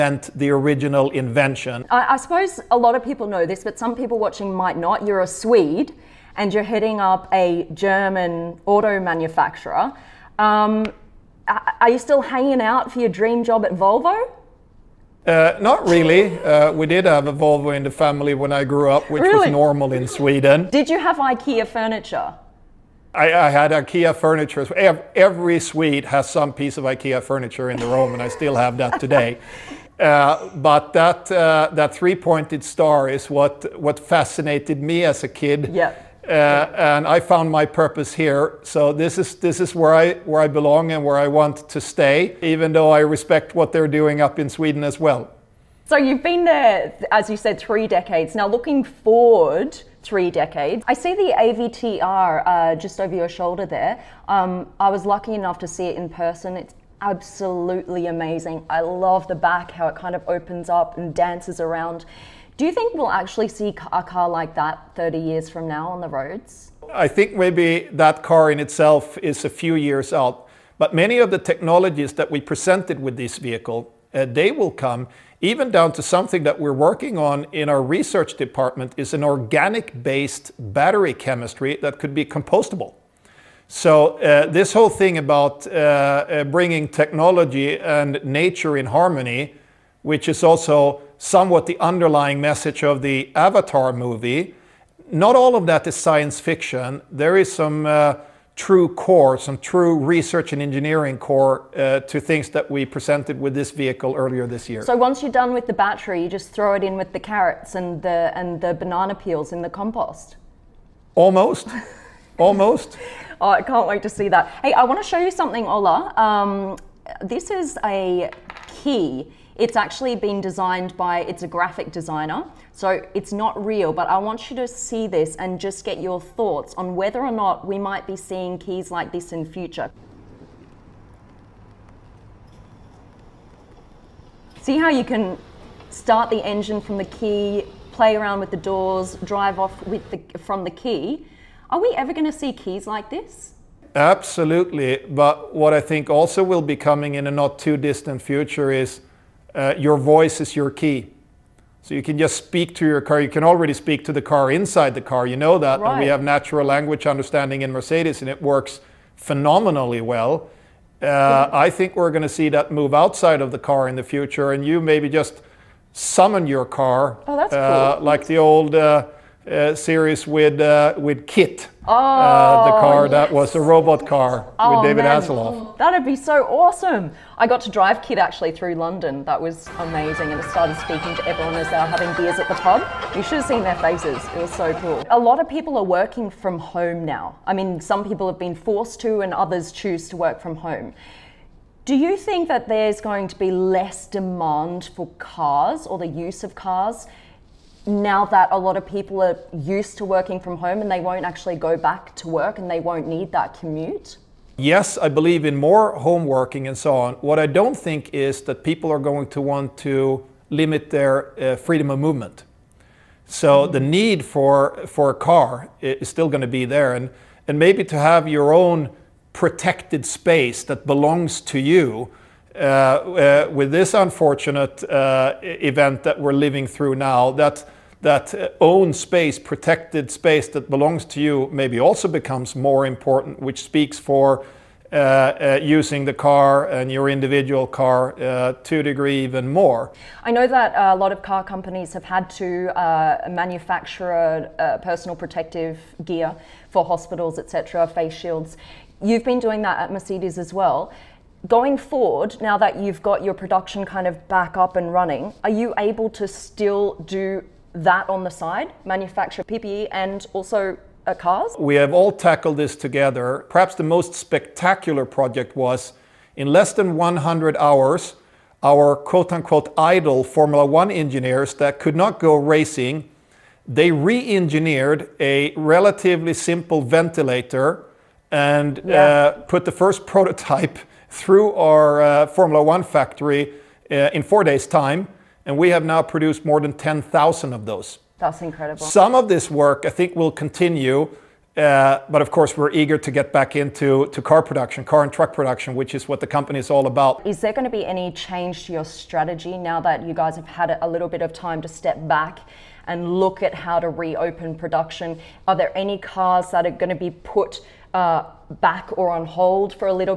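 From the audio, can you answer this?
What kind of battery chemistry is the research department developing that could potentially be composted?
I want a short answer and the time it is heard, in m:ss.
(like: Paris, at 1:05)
organic-based, at 1:19.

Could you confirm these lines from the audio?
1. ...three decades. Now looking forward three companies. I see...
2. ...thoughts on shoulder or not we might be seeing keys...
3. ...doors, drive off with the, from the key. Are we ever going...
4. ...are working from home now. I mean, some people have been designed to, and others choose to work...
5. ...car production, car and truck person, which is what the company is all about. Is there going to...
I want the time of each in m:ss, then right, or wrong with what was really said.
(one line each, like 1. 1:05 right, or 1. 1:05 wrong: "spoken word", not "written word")
1. 0:47 wrong: "decades", not "companies"
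2. 2:06 wrong: "whether", not "shoulder"
3. 2:18 right
4. 3:05 wrong: "forced", not "designed"
5. 4:54 wrong: "production", not "person".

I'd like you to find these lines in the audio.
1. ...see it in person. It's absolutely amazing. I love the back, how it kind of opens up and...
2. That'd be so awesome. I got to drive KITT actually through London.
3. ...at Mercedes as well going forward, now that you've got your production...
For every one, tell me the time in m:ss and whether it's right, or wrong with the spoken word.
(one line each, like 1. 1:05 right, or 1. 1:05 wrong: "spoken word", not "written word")
1. 0:55 right
2. 2:55 right
3. 4:09 right.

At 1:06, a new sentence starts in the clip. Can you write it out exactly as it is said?
I think maybe that car in itself is a few years out.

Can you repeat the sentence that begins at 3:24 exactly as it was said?
Yes, I believe in more home working and so on.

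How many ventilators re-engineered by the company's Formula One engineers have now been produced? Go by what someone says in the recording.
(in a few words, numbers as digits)
More than 10,000.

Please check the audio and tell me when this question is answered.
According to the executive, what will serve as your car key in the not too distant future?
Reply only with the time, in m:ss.
2:29.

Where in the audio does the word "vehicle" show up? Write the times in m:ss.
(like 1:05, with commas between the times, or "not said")
1:13, 1:43.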